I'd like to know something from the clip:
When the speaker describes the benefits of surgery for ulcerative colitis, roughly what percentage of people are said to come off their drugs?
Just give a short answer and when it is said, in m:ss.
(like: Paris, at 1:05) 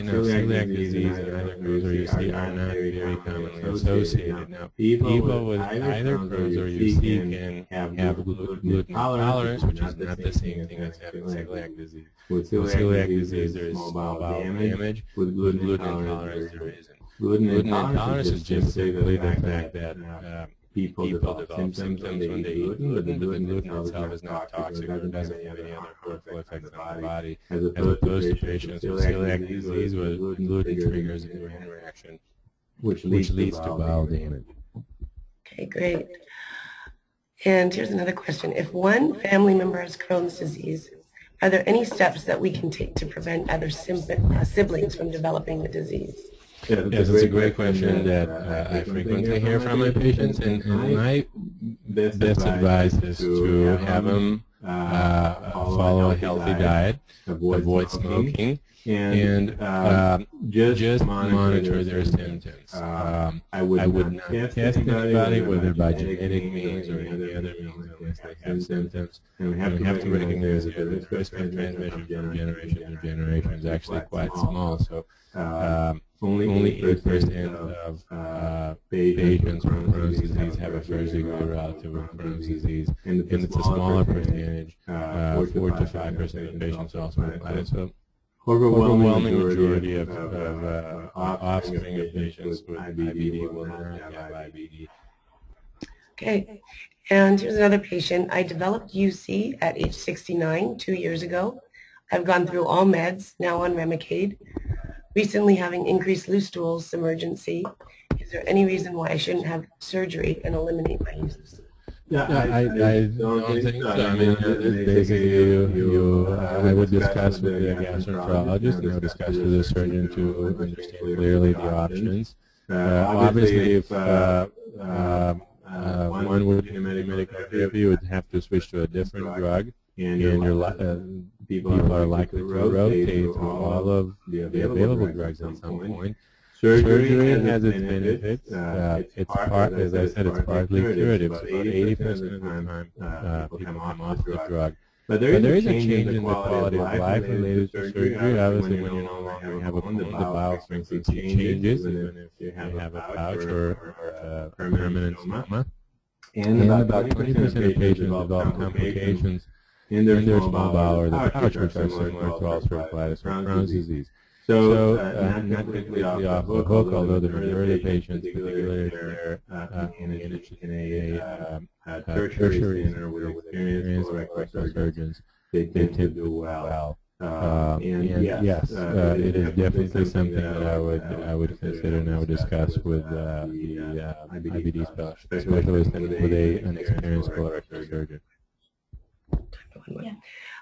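80%, at 2:21.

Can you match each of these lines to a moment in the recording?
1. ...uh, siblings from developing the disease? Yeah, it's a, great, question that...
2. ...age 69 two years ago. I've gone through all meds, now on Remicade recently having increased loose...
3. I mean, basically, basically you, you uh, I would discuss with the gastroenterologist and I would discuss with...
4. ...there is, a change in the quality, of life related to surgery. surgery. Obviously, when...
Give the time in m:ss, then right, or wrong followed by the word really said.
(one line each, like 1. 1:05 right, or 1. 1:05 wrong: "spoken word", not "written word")
1. 0:43 right
2. 1:39 right
3. 1:53 right
4. 2:25 right.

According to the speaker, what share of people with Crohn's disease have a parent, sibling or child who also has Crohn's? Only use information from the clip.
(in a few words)
8%.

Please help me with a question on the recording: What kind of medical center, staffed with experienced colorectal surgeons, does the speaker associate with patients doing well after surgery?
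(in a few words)
Tertiary center.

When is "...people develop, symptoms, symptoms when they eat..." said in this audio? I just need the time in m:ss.
0:21.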